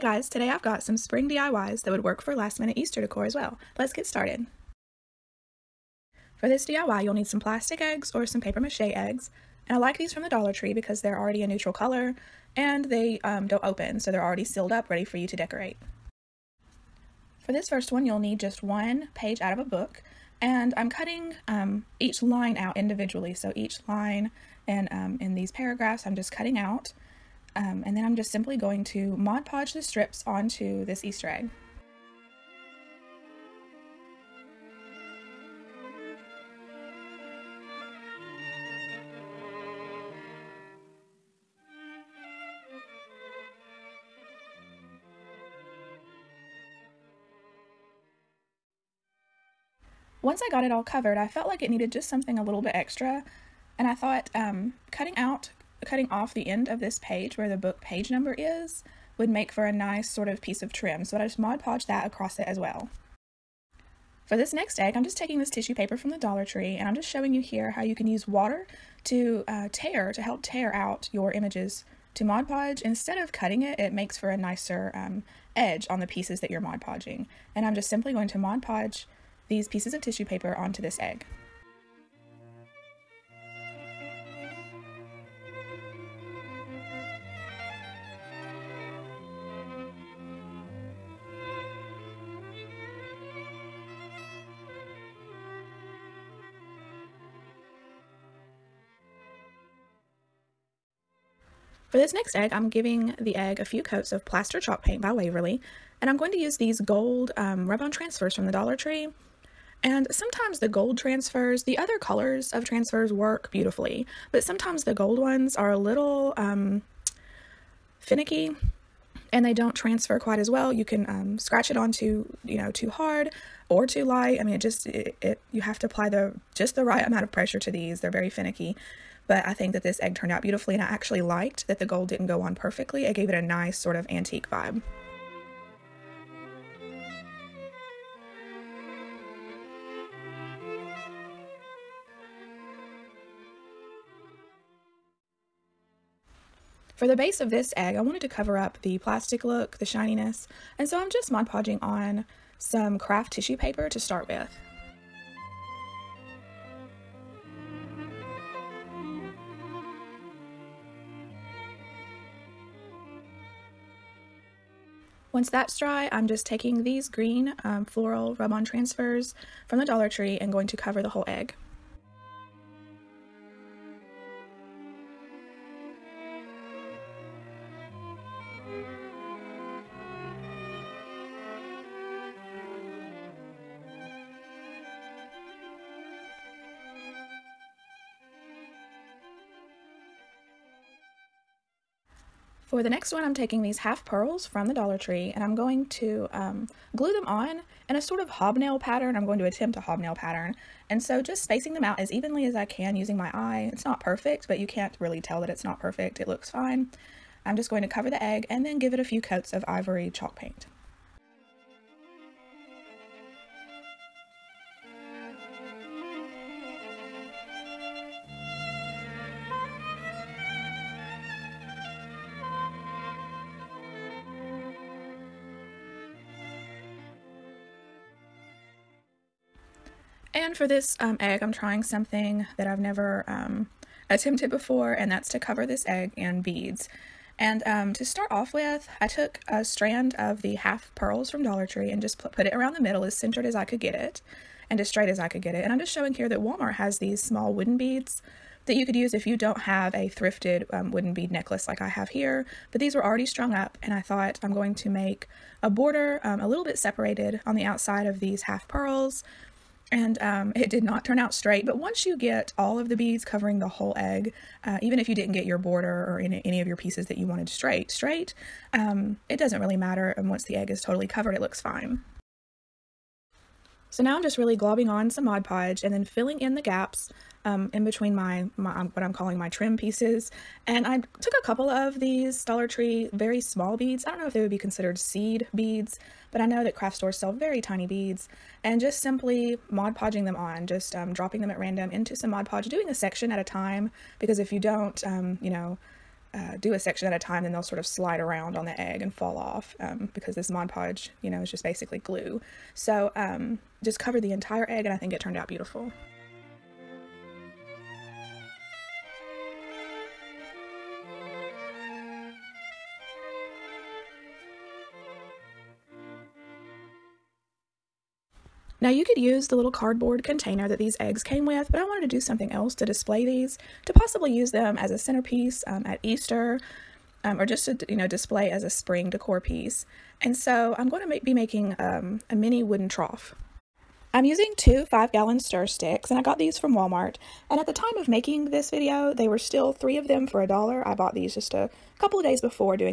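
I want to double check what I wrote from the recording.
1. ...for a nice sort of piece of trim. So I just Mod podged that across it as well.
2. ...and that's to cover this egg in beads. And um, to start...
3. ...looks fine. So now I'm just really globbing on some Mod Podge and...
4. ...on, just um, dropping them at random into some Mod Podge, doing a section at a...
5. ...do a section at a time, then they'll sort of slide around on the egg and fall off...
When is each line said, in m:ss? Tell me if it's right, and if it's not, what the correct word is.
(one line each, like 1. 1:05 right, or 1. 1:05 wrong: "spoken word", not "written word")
1. 0:59 right
2. 3:54 right
3. 4:31 right
4. 4:50 right
5. 4:56 right.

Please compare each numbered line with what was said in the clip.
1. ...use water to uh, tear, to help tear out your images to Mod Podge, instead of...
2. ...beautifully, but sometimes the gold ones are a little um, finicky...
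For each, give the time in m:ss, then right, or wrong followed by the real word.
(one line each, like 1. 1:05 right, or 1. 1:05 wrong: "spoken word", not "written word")
1. 1:08 right
2. 1:53 right.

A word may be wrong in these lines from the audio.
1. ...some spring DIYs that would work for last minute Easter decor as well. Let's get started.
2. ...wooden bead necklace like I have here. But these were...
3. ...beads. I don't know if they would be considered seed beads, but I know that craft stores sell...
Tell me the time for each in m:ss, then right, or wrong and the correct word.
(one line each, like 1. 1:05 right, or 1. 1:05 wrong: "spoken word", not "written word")
1. 0:00 right
2. 4:10 right
3. 4:43 right.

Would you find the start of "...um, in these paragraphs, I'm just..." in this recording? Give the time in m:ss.
0:24.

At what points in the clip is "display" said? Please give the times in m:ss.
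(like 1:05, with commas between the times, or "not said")
5:22, 5:28.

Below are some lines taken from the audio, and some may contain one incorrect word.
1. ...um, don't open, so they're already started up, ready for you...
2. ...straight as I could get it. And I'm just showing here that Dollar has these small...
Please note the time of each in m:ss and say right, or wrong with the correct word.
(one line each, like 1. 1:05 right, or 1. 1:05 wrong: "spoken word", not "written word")
1. 0:13 wrong: "sealed", not "started"
2. 4:04 wrong: "Walmart", not "Dollar".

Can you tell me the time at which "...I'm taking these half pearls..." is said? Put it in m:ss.
3:13.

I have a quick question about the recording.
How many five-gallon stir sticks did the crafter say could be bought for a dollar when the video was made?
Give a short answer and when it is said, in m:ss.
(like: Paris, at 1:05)
3, at 5:39.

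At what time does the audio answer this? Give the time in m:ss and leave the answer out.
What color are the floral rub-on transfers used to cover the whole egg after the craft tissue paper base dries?
2:47.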